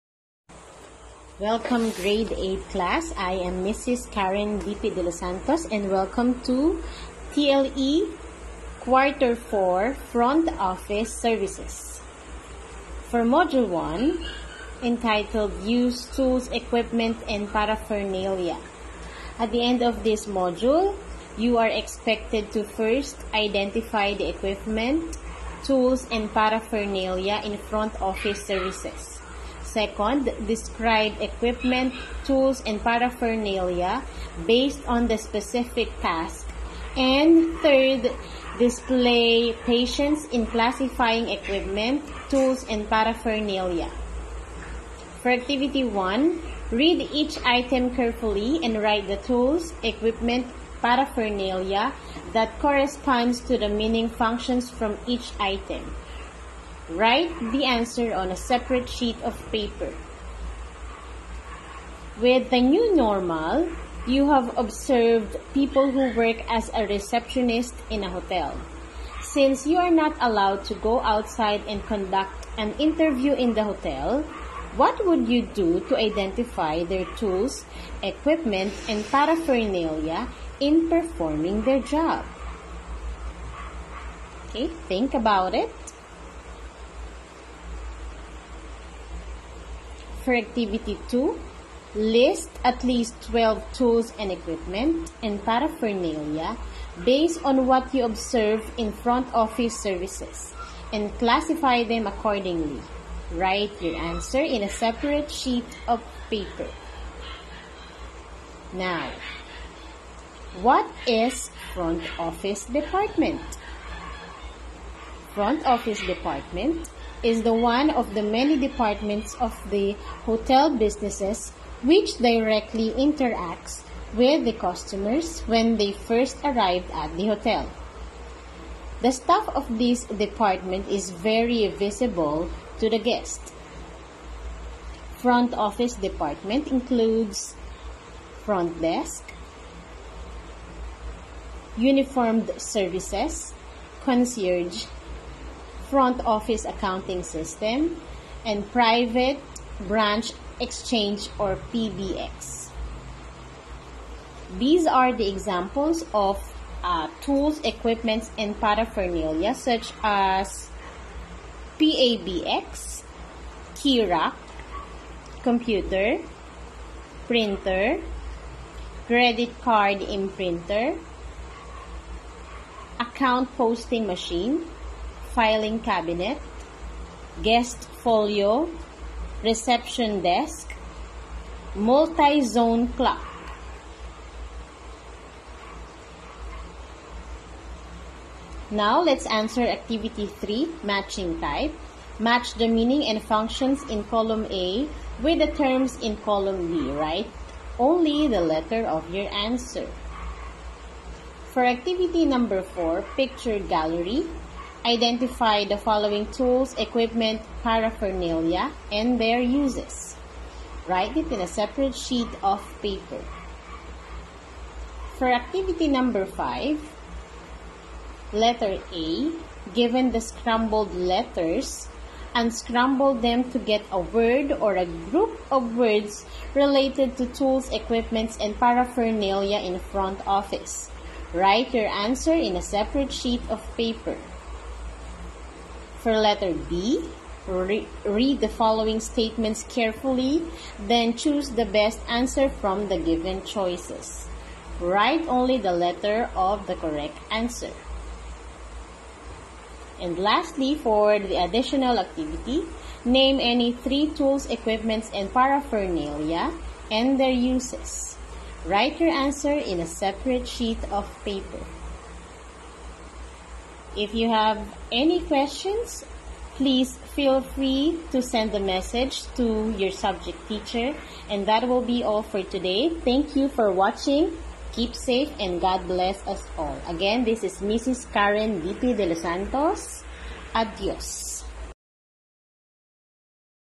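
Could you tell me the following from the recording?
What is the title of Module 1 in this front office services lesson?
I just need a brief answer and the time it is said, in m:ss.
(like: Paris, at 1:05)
Use Tools, Equipment, and Paraphernalia, at 0:15.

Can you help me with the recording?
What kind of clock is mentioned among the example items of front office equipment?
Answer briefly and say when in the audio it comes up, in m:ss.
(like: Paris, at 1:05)
Multi-zone clock, at 3:01.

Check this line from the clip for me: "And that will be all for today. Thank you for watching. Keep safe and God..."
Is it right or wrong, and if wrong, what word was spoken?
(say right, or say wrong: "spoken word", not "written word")
right.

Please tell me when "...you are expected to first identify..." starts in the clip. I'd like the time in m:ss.
0:21.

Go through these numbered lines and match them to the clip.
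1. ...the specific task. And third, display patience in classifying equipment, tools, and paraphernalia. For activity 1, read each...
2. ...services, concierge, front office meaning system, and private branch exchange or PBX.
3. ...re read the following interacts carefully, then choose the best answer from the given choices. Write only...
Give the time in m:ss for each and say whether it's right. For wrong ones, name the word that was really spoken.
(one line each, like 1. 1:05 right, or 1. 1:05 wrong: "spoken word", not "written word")
1. 0:35 right
2. 2:22 wrong: "accounting", not "meaning"
3. 3:57 wrong: "statements", not "interacts".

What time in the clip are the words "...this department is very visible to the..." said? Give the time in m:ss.
2:09.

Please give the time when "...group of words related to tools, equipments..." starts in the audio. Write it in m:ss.
3:44.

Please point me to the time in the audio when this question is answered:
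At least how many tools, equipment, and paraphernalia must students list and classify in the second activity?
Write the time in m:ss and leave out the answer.
1:33.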